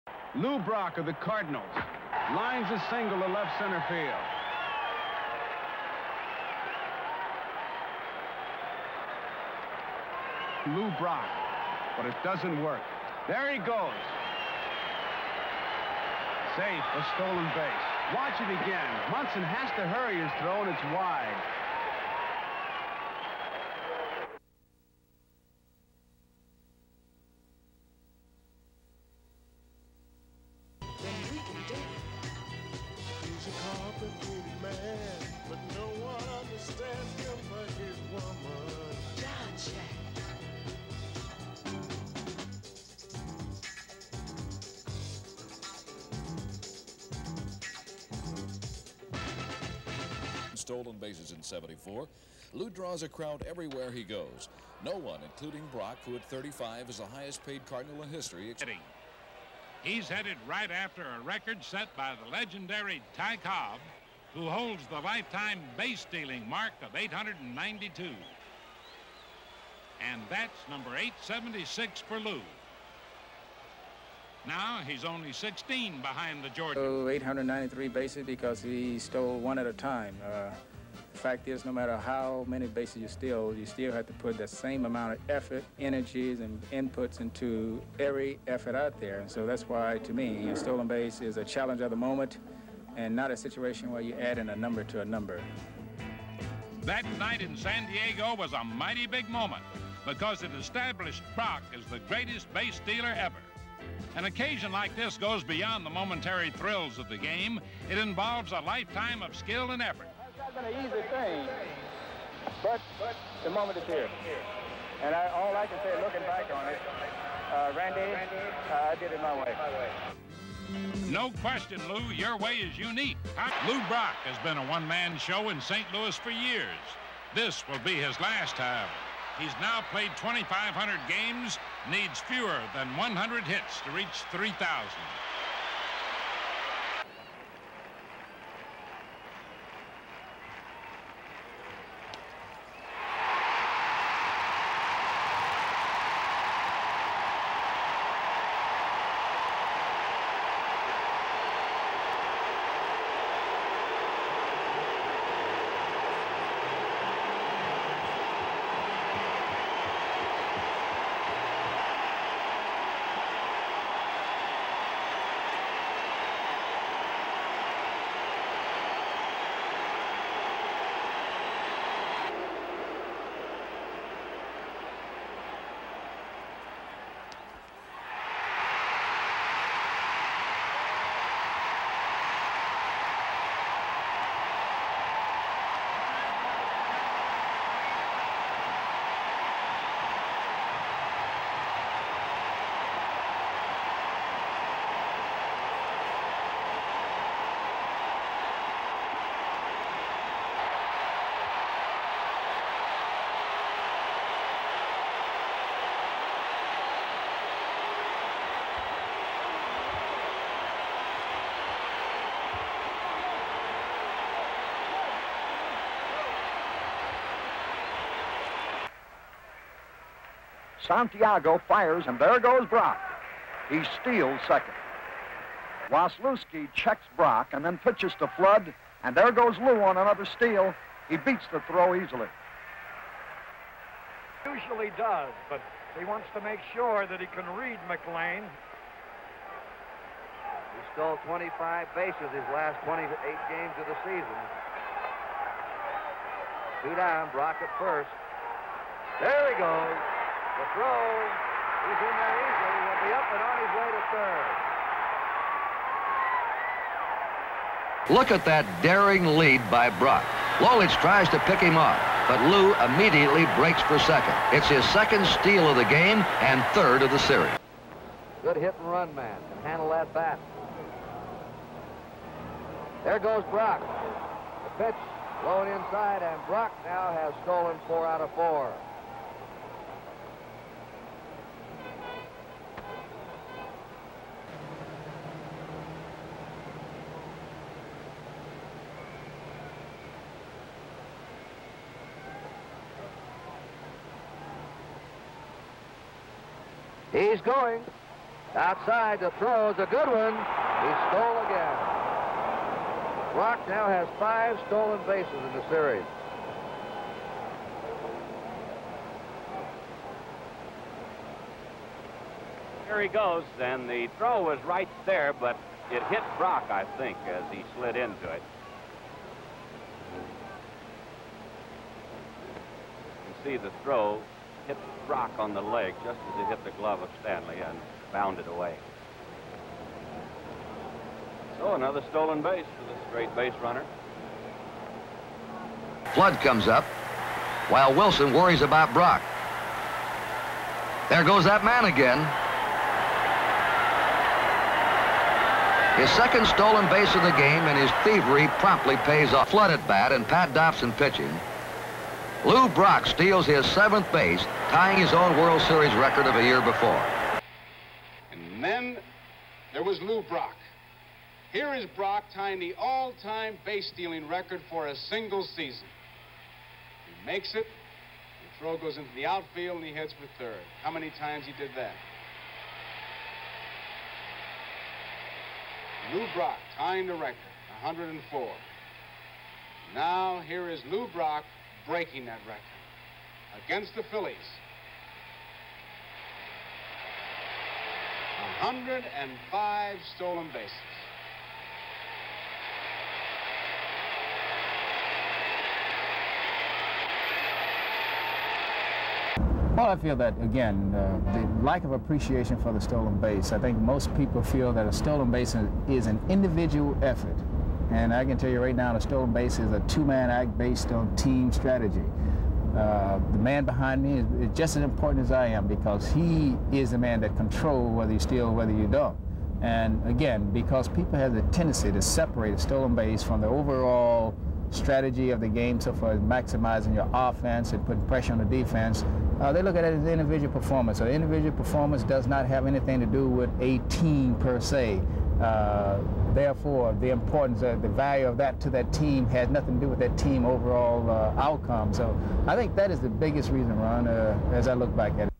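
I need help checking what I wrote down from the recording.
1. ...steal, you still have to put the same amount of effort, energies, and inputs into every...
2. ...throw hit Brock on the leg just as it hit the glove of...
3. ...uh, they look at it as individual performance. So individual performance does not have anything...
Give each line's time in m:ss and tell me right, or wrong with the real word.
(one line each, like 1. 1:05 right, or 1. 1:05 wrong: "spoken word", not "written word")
1. 1:23 right
2. 5:23 right
3. 7:09 right.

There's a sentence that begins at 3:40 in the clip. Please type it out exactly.
Santiago fires, and there goes Brock.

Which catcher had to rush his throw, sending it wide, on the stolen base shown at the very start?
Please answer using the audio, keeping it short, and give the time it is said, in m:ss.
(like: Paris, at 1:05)
Munson, at 0:19.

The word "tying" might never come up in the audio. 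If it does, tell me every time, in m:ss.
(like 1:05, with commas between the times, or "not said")
5:54, 6:02, 6:16.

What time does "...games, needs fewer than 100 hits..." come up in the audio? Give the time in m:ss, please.
2:11.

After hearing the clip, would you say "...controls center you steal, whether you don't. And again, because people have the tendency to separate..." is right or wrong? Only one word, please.
wrong.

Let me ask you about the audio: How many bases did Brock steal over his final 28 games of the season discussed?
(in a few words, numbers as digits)
25.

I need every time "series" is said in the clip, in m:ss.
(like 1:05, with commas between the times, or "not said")
4:27, 5:05, 5:55.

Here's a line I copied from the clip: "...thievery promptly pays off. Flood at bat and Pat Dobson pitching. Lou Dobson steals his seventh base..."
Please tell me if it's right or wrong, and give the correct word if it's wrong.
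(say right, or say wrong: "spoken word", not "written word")
wrong: "Brock", not "Dobson".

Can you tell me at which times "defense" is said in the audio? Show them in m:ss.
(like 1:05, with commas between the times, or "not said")
7:08.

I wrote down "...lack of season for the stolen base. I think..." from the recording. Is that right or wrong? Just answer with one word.
wrong.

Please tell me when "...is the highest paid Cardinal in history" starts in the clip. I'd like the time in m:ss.
0:56.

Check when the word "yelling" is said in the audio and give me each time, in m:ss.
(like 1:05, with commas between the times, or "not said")
not said.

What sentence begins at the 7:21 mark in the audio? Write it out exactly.
So I think that is the biggest reason, Ron, uh, as I look back at it.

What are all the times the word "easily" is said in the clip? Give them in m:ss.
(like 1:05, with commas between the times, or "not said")
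3:51, 4:12.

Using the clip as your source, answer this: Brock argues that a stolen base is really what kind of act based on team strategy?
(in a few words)
A two-man act.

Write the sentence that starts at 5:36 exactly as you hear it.
Flood comes up while Wilson worries about Brock.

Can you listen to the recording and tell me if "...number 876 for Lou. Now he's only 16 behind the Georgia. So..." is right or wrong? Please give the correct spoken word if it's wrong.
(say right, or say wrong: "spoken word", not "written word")
right.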